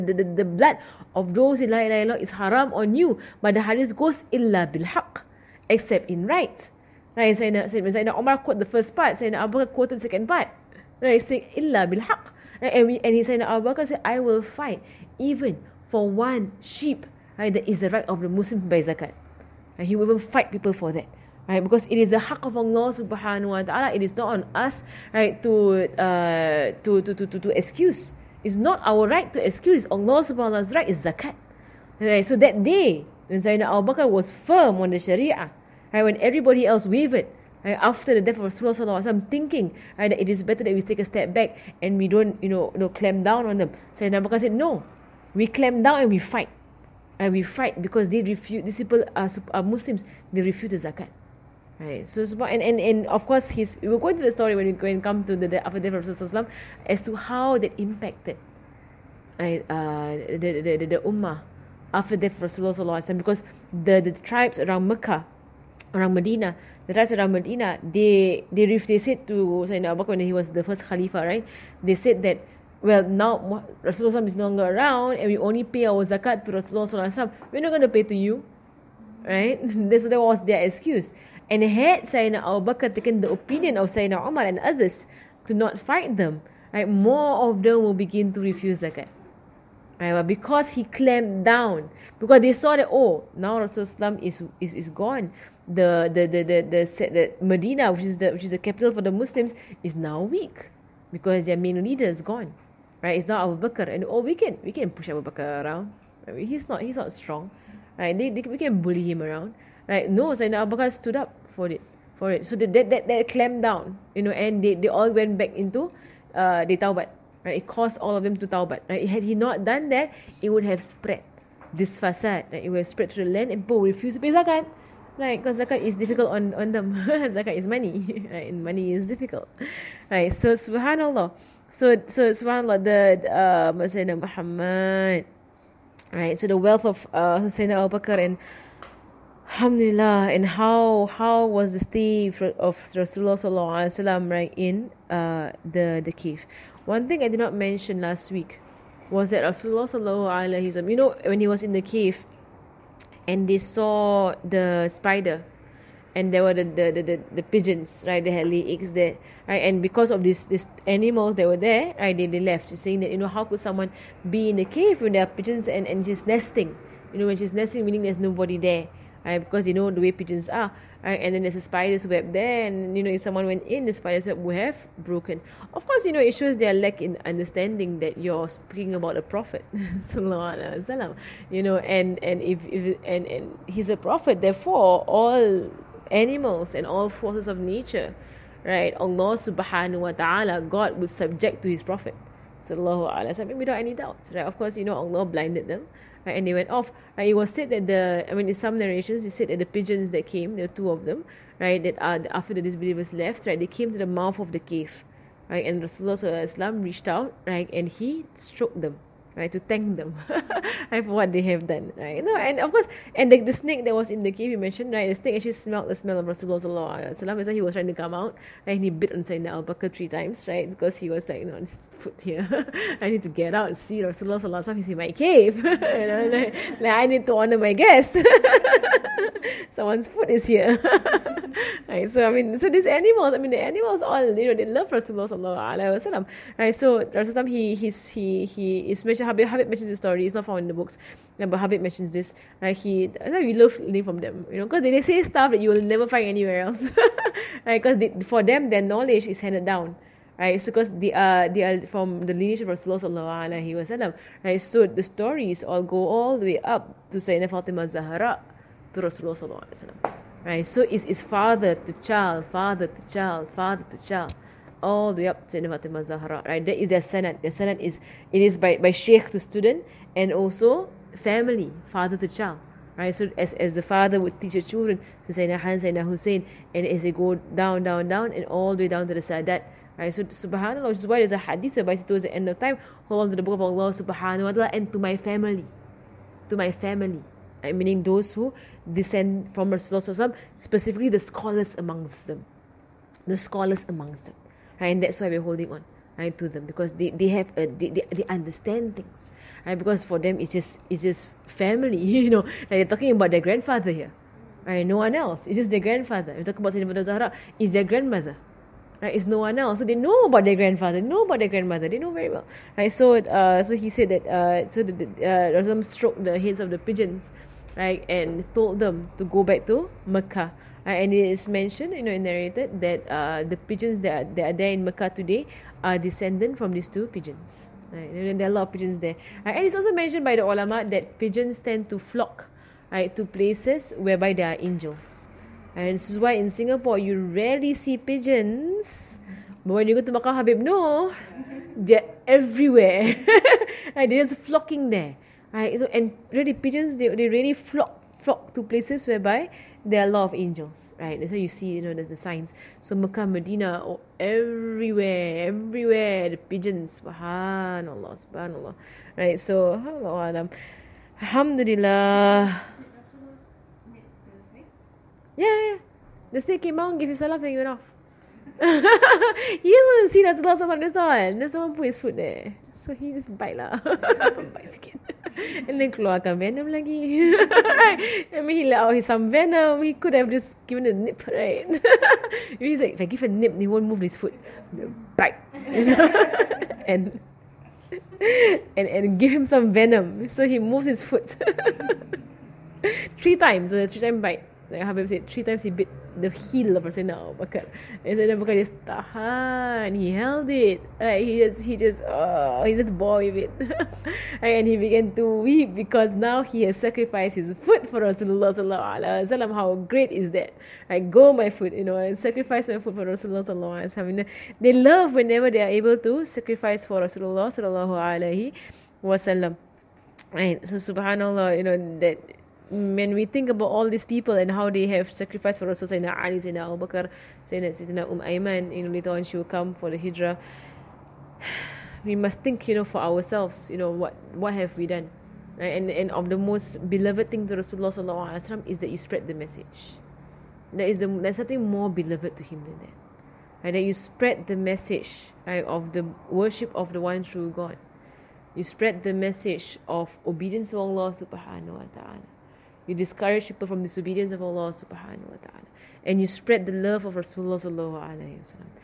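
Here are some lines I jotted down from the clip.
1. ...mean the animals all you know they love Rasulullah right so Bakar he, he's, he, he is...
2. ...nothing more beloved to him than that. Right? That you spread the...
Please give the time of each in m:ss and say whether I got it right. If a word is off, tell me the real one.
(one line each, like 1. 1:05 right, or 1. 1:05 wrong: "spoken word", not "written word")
1. 3:53 wrong: "Rasulullah", not "Bakar"
2. 7:21 right.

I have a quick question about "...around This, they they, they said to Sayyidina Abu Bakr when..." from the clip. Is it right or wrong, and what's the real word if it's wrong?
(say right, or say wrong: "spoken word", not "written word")
wrong: "Medina", not "This".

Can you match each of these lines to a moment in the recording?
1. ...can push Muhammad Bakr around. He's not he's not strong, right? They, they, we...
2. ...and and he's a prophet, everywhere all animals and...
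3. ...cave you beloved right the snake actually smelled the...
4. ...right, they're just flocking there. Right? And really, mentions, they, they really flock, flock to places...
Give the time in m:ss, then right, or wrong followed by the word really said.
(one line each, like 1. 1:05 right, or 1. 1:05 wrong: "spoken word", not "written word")
1. 1:44 wrong: "Abu", not "Muhammad"
2. 3:03 wrong: "therefore", not "everywhere"
3. 3:34 wrong: "mentioned", not "beloved"
4. 5:43 wrong: "pigeons", not "mentions".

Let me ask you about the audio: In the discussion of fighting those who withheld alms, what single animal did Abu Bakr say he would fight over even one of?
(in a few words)
sheep.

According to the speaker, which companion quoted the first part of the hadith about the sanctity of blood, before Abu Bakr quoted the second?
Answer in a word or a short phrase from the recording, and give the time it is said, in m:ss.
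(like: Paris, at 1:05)
Omar, at 0:07.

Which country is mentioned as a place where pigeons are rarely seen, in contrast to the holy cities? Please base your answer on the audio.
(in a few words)
Singapore.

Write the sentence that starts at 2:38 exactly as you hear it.
They had lay eggs there, right?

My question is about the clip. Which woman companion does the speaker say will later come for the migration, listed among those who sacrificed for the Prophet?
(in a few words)
Um Ayman.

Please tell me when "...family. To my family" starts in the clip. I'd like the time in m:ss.
4:45.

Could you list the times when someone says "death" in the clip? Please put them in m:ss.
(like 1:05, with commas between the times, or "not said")
0:38, 0:55, 1:02.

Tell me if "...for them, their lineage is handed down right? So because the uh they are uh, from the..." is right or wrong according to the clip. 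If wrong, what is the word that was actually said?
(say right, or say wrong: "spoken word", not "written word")
wrong: "knowledge", not "lineage".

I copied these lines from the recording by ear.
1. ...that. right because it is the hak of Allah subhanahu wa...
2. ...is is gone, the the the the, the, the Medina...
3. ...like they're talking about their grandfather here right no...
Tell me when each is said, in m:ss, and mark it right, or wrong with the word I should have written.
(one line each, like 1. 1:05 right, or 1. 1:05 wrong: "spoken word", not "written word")
1. 0:20 right
2. 1:34 right
3. 5:02 right.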